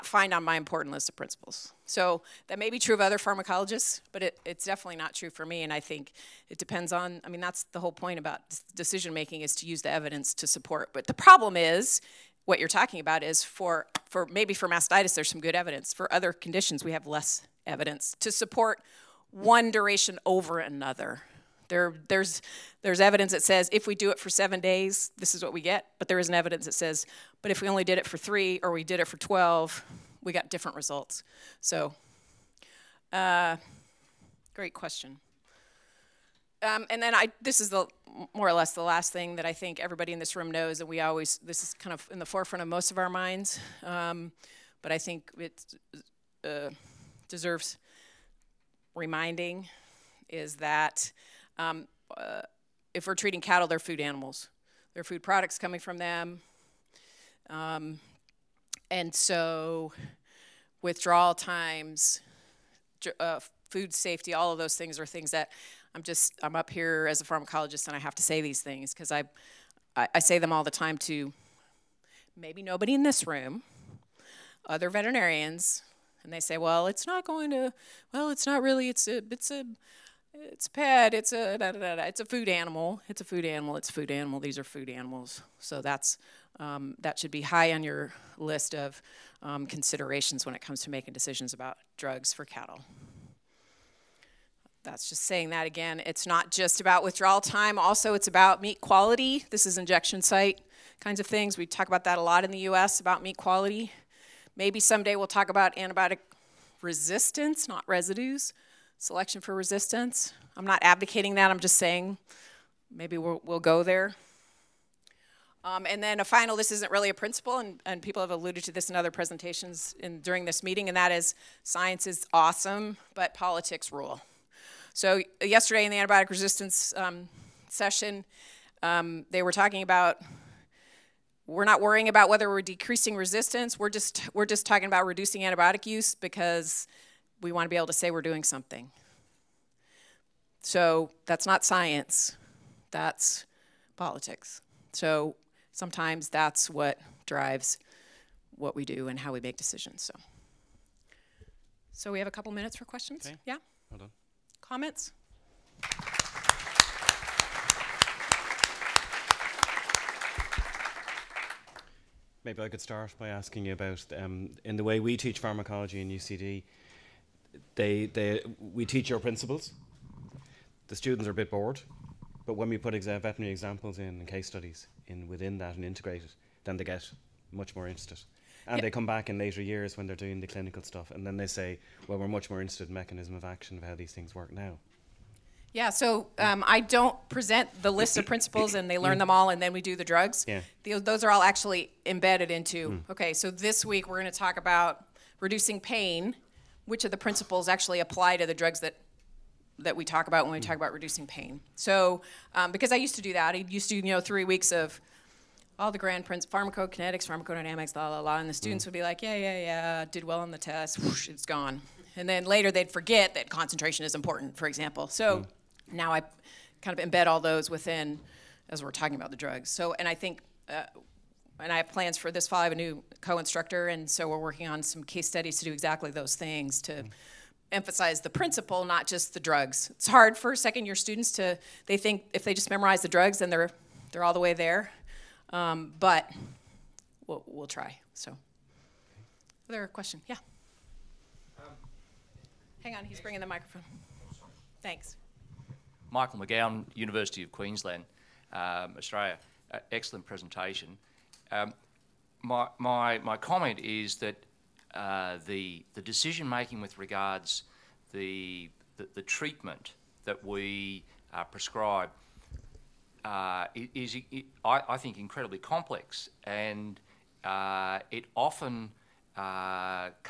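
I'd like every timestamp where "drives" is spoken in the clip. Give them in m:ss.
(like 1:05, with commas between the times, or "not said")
2:27.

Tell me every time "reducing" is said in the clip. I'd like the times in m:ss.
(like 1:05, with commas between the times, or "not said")
2:15, 3:15, 3:20.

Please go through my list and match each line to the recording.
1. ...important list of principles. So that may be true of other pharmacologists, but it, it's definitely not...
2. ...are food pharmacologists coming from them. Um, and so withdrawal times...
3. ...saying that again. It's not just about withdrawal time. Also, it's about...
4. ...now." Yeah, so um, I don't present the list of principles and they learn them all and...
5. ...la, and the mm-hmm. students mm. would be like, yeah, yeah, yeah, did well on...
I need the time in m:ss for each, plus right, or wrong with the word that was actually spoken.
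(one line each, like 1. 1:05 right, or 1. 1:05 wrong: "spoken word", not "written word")
1. 0:00 right
2. 0:55 wrong: "products", not "pharmacologists"
3. 1:35 right
4. 3:04 right
5. 3:28 right.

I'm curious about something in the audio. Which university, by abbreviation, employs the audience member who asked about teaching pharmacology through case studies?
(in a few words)
UCD.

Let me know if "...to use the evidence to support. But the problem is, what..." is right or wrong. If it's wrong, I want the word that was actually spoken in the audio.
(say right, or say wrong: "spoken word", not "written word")
right.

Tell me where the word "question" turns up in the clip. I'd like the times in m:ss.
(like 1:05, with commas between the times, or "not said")
0:34, 2:32, 3:59.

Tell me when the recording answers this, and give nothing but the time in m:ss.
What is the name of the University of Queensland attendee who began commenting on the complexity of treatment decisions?
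4:06.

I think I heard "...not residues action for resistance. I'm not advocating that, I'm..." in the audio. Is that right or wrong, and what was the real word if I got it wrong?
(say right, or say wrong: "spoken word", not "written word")
wrong: "selection", not "action".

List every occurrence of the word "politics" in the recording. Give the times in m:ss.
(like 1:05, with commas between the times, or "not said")
2:03, 2:23.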